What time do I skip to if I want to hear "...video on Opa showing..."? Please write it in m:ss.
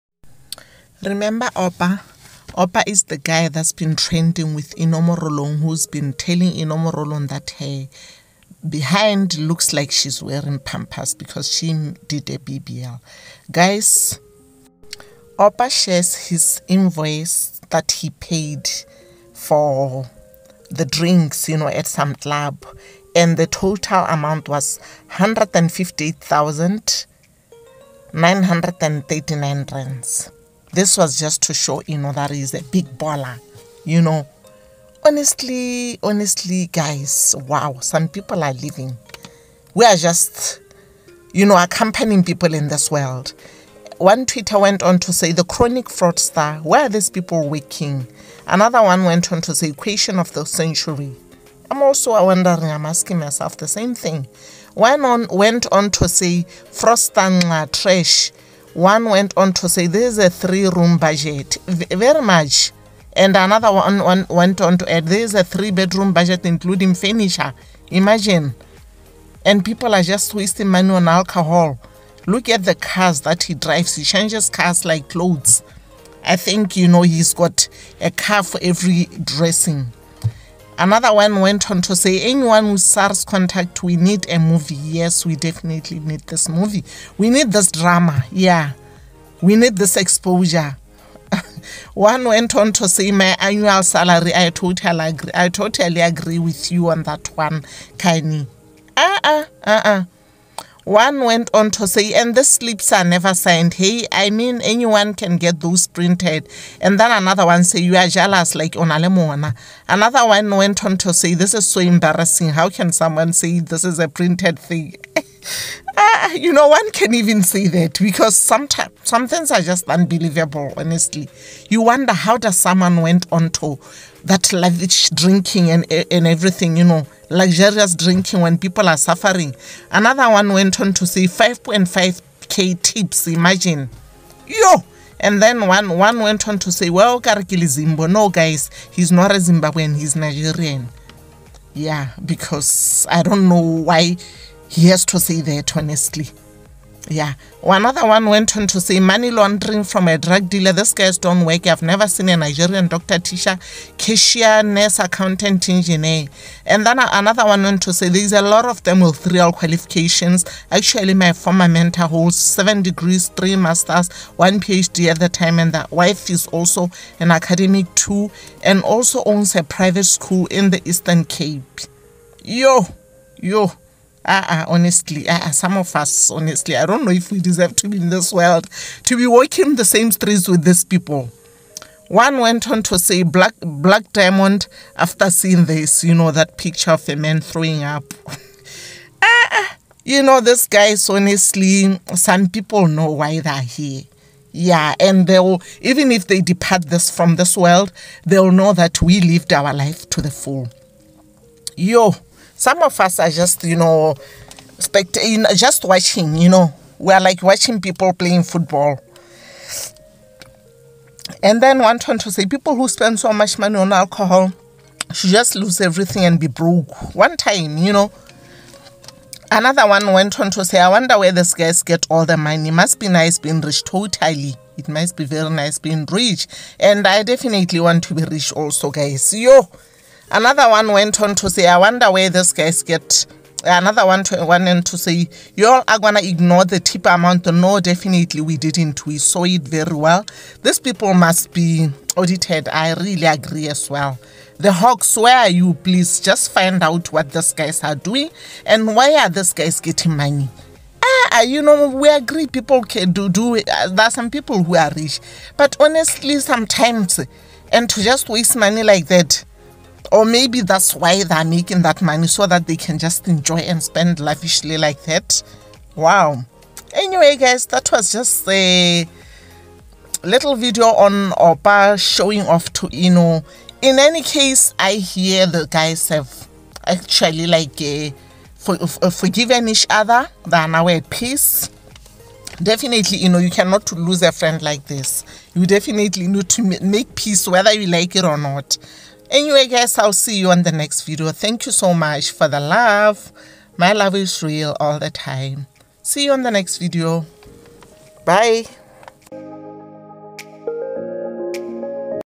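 4:30.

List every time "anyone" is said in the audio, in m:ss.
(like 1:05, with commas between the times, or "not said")
1:22, 1:44.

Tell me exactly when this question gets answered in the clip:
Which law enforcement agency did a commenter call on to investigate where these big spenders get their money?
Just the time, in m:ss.
4:04.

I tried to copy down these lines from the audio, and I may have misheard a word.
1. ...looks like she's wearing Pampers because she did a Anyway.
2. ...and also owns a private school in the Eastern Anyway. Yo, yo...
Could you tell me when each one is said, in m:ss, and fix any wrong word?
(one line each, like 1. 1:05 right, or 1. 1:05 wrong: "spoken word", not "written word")
1. 0:09 wrong: "BBL", not "Anyway"
2. 2:48 wrong: "Cape", not "Anyway".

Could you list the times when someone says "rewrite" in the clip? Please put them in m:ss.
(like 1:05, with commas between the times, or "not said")
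not said.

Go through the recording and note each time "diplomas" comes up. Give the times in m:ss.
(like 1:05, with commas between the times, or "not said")
not said.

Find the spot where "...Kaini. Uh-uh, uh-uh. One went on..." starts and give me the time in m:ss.
1:37.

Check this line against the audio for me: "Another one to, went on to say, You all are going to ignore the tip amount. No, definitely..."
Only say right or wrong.
right.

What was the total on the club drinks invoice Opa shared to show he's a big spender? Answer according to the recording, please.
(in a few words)
R158,939.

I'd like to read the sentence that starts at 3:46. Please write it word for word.
And I definitely want to be rich also, guys.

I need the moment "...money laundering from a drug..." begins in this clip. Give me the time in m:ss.
2:28.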